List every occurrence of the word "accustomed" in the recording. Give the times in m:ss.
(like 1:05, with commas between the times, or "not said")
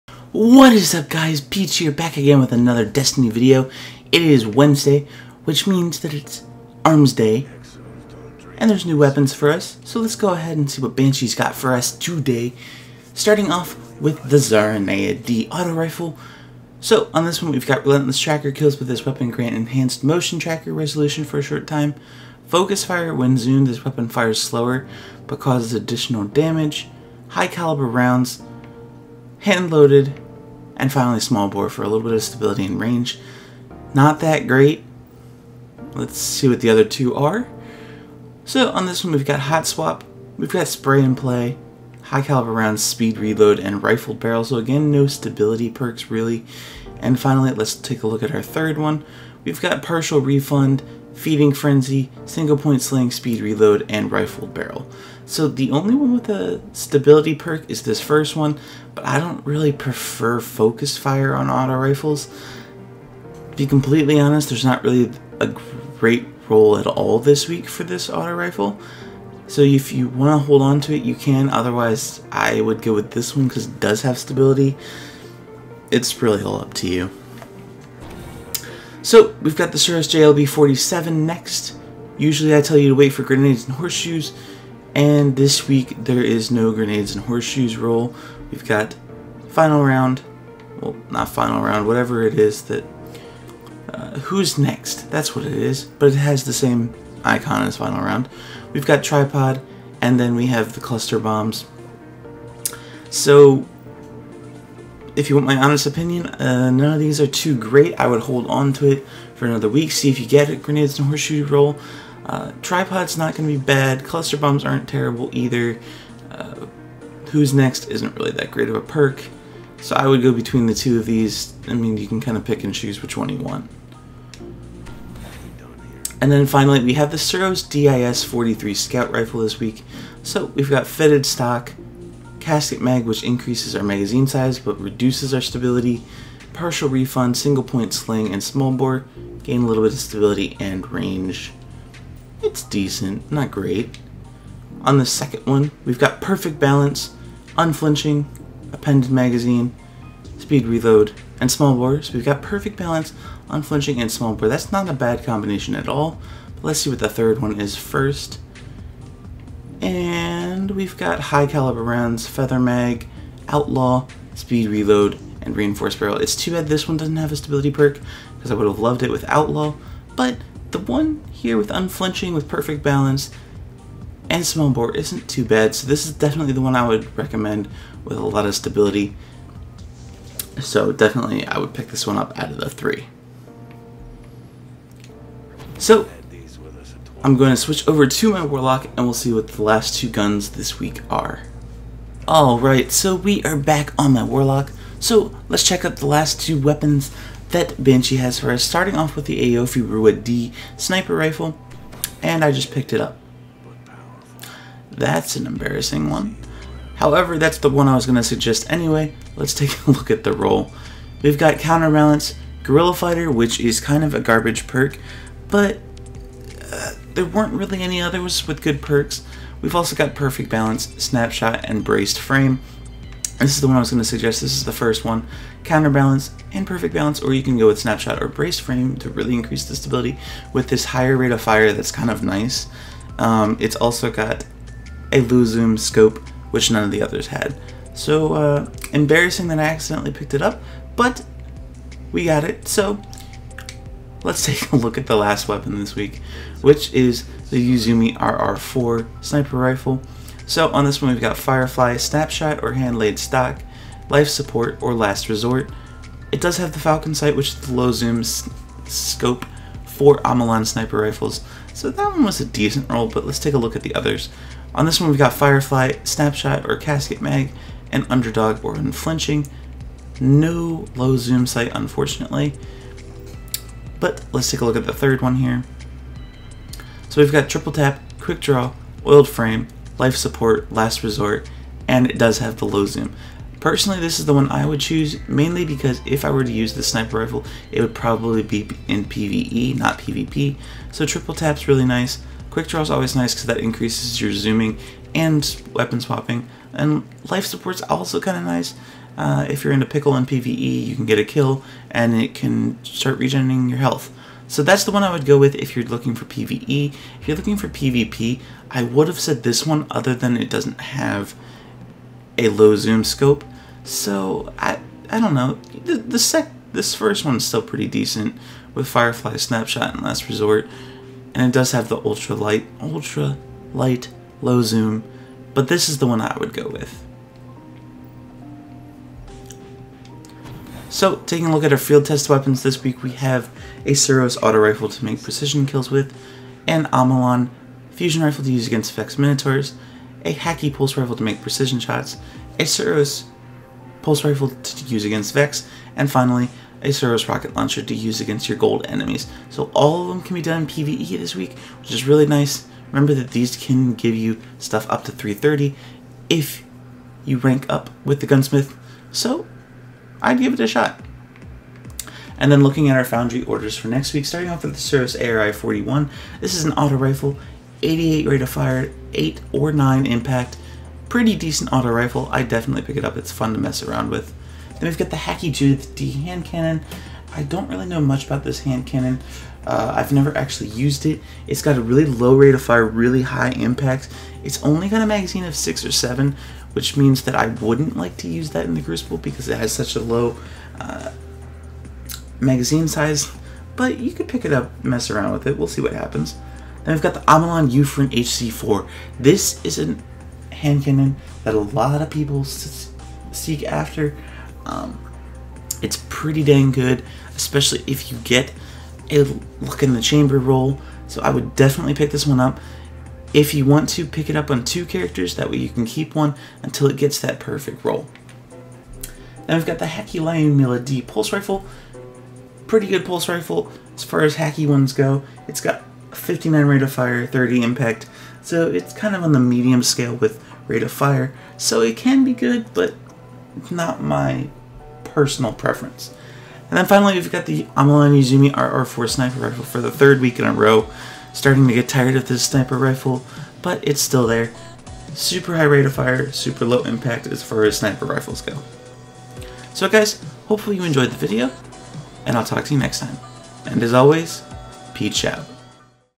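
not said.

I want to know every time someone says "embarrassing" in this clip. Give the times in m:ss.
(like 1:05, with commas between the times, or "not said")
3:25, 3:58.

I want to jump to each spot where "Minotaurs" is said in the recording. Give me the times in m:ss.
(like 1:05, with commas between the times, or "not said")
5:39.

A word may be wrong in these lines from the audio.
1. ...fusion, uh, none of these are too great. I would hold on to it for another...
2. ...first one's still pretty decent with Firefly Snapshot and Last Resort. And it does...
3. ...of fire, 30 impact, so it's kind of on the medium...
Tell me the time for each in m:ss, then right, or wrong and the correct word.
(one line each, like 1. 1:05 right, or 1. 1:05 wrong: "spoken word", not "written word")
1. 1:45 wrong: "opinion", not "fusion"
2. 5:16 right
3. 7:06 right.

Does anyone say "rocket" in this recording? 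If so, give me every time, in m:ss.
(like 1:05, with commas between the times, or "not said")
5:47.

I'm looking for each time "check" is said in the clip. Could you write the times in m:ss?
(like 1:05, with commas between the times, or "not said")
3:15.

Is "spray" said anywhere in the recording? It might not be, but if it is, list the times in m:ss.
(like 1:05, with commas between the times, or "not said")
0:40.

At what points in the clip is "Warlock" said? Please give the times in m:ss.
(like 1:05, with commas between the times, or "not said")
3:08, 3:14.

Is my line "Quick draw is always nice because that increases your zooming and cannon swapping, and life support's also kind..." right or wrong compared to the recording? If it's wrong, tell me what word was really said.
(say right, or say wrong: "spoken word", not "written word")
wrong: "weapon", not "cannon".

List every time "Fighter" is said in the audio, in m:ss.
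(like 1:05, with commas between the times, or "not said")
3:32.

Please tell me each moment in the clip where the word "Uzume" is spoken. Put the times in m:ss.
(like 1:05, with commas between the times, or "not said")
4:07, 7:18.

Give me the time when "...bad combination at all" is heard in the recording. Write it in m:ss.
2:34.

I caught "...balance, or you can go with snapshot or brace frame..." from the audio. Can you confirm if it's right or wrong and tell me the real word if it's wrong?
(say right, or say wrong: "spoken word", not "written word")
right.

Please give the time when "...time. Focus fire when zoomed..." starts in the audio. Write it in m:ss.
0:21.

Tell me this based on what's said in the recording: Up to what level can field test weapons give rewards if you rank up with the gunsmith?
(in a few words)
330.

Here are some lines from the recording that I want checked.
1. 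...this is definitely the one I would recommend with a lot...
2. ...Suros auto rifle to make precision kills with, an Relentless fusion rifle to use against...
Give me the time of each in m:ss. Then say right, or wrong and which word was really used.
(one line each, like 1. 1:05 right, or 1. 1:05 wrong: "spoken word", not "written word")
1. 2:55 right
2. 5:33 wrong: "Omolon", not "Relentless".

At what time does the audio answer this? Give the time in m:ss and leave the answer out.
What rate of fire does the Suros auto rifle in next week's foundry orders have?
6:07.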